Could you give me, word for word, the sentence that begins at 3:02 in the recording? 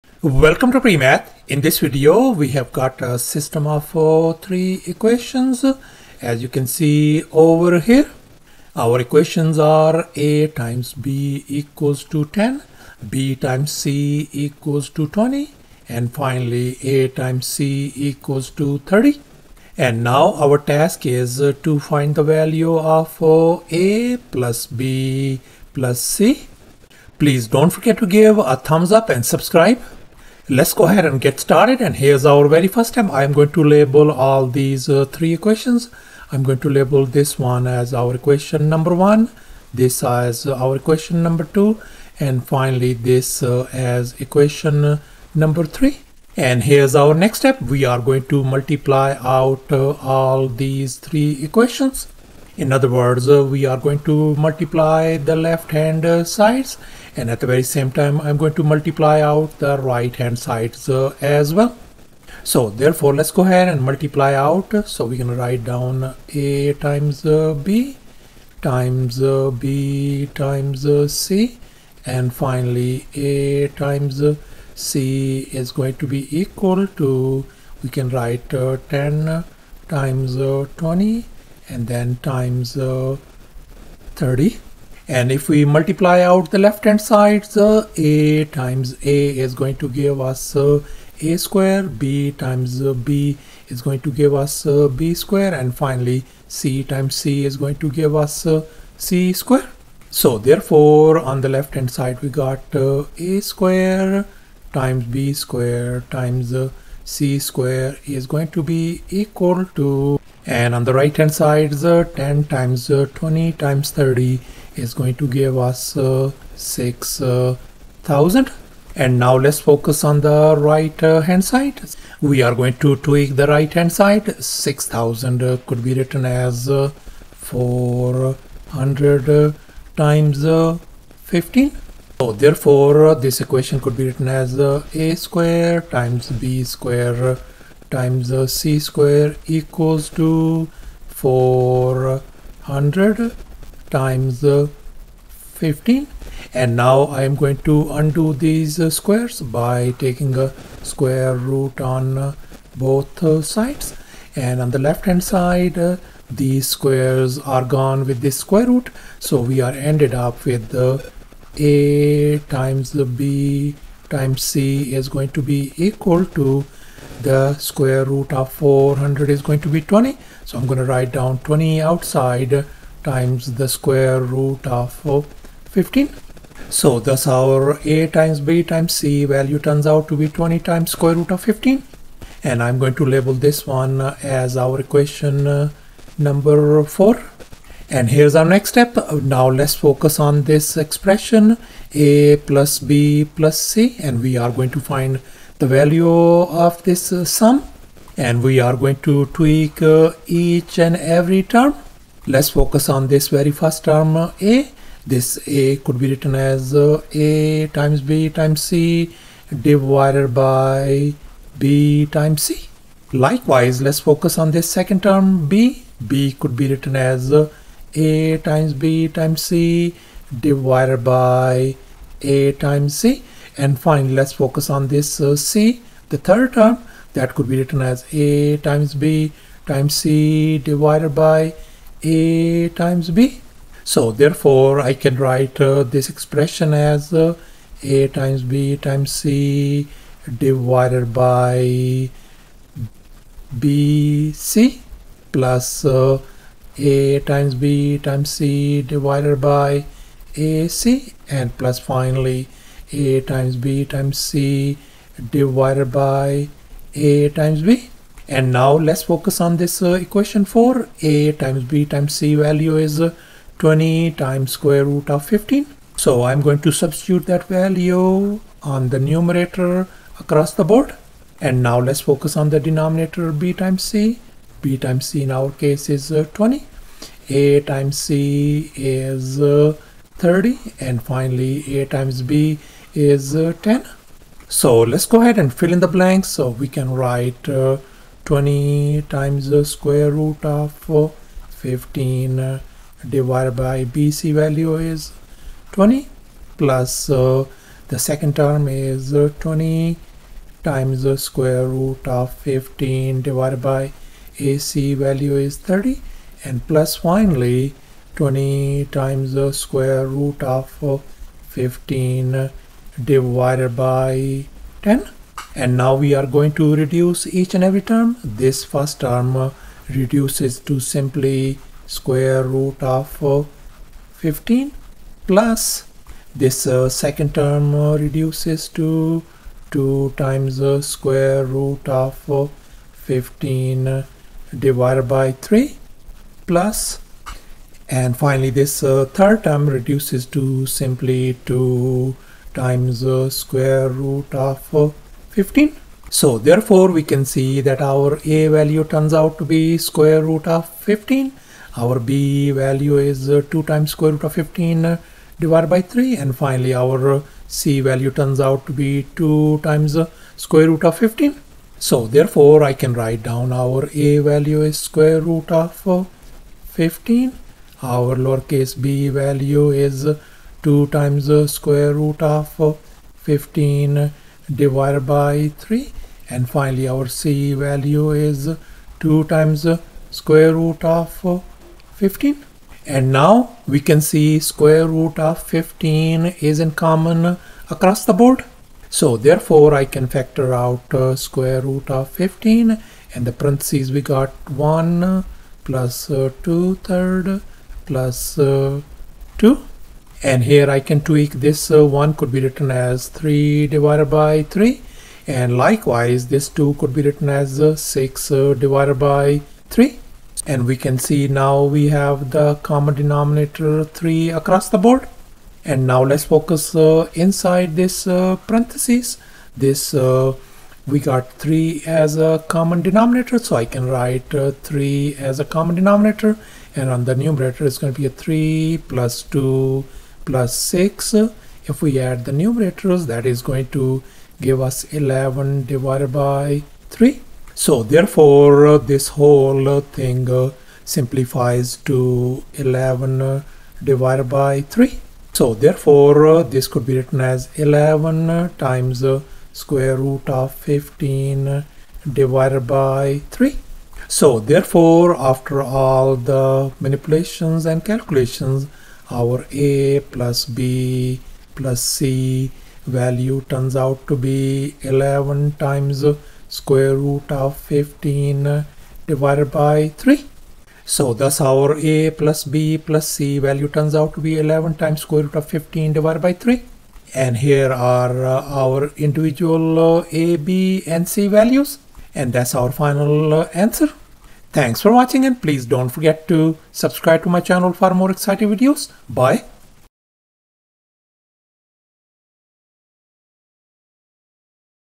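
And I'm going to label this one as our equation uh, number 4.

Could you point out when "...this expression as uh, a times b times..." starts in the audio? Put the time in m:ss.
3:55.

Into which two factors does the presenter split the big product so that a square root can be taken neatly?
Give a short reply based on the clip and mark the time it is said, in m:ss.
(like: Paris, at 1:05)
400 times 15, at 2:07.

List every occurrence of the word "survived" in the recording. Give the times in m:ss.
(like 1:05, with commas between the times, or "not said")
not said.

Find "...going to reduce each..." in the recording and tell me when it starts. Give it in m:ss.
5:16.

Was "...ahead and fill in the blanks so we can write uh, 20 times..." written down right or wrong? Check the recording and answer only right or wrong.
right.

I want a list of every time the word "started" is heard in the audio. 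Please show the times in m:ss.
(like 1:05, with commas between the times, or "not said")
0:31.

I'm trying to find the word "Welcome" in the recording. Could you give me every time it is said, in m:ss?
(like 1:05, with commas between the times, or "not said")
0:00.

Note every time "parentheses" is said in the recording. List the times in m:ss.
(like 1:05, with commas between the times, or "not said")
6:33, 6:58.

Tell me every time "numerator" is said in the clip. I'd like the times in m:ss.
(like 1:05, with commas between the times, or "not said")
4:28, 7:07, 7:12.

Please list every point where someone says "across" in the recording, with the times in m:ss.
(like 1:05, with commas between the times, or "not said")
4:30, 6:27, 6:54.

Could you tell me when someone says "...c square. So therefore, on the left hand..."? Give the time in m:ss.
1:38.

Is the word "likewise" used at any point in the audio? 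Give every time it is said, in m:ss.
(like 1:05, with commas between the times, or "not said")
3:33, 6:45.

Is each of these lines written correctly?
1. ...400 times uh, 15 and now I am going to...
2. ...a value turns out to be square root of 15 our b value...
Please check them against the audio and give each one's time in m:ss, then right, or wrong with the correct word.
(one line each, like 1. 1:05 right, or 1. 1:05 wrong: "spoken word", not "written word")
1. 2:21 right
2. 5:48 right.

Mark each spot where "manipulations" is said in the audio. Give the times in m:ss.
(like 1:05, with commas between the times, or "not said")
7:36.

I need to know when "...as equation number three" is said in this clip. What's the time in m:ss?
0:43.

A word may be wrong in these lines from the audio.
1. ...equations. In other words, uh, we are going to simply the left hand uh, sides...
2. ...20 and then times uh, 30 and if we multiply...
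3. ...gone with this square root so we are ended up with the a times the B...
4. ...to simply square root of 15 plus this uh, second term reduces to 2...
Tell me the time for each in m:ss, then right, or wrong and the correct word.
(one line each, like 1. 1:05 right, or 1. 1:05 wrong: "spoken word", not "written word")
1. 0:51 wrong: "multiply", not "simply"
2. 1:20 right
3. 2:37 right
4. 5:20 right.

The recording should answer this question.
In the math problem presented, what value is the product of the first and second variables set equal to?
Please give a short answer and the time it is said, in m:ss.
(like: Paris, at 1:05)
10, at 0:10.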